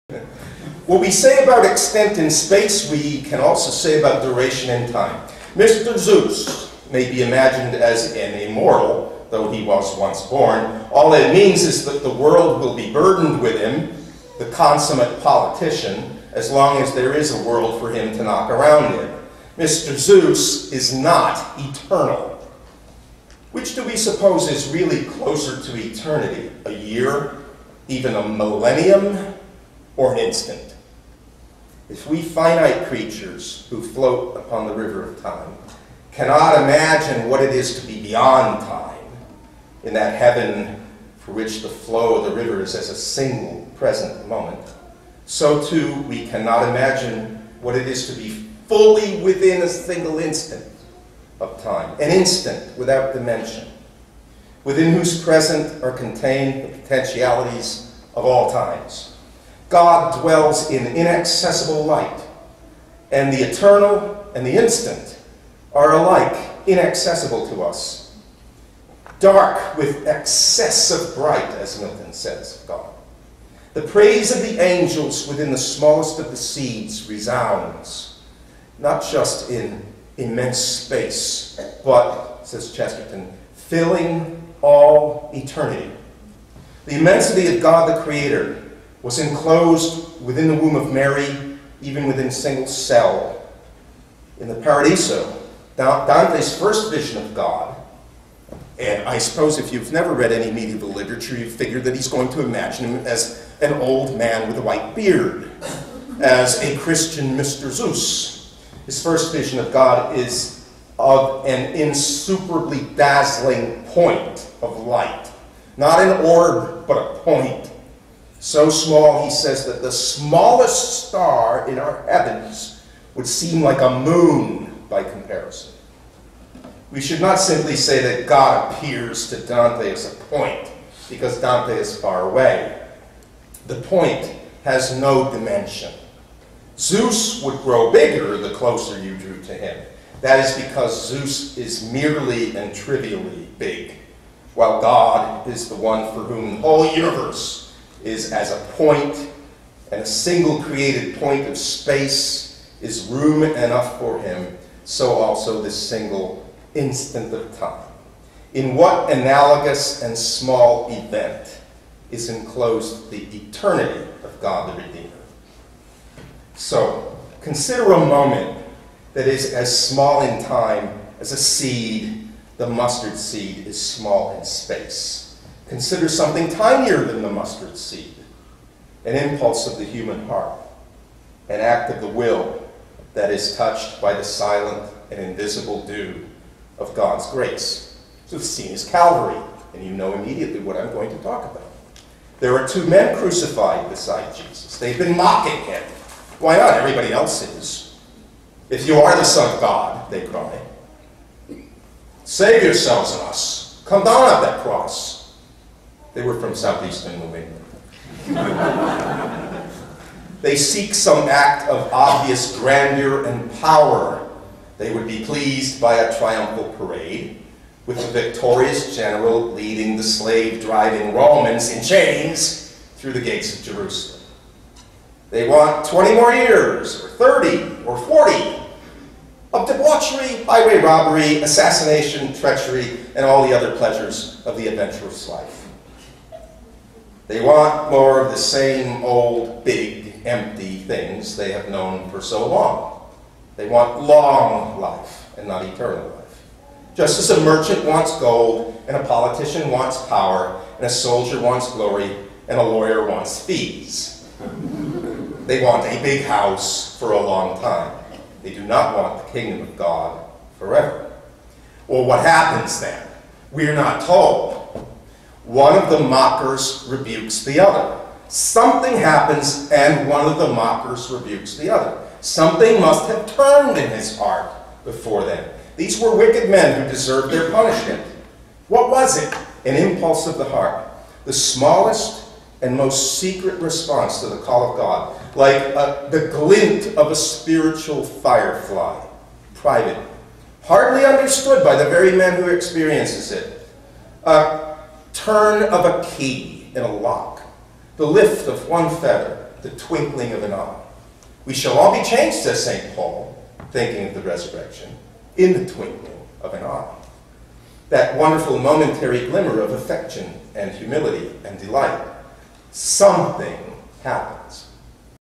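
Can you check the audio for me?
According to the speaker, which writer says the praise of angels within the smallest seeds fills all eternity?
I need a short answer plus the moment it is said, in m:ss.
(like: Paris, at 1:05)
Chesterton, at 1:22.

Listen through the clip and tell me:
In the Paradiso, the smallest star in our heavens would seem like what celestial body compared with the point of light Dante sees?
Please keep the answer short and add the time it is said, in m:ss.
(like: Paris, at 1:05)
a moon, at 2:03.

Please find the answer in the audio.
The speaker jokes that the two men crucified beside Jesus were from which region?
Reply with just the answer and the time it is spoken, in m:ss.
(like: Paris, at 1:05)
southeastern New England, at 3:26.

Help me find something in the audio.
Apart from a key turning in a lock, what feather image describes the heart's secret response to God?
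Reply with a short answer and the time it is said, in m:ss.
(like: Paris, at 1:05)
the lift of one feather, at 4:57.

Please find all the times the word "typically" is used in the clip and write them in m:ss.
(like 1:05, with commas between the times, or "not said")
not said.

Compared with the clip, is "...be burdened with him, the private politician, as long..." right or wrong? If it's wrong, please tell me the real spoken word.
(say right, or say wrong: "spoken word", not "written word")
wrong: "consummate", not "private".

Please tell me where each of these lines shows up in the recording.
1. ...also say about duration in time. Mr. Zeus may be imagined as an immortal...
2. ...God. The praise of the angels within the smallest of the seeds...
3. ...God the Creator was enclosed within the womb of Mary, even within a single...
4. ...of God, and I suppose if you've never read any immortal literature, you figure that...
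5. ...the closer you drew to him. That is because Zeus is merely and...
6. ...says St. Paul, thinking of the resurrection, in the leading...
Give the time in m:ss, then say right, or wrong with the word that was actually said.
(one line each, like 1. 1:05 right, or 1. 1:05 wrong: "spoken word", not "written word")
1. 0:03 right
2. 1:12 right
3. 1:27 right
4. 1:37 wrong: "medieval", not "immortal"
5. 2:18 right
6. 5:02 wrong: "twinkling", not "leading".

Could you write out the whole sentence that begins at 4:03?
They want long life and not eternal life.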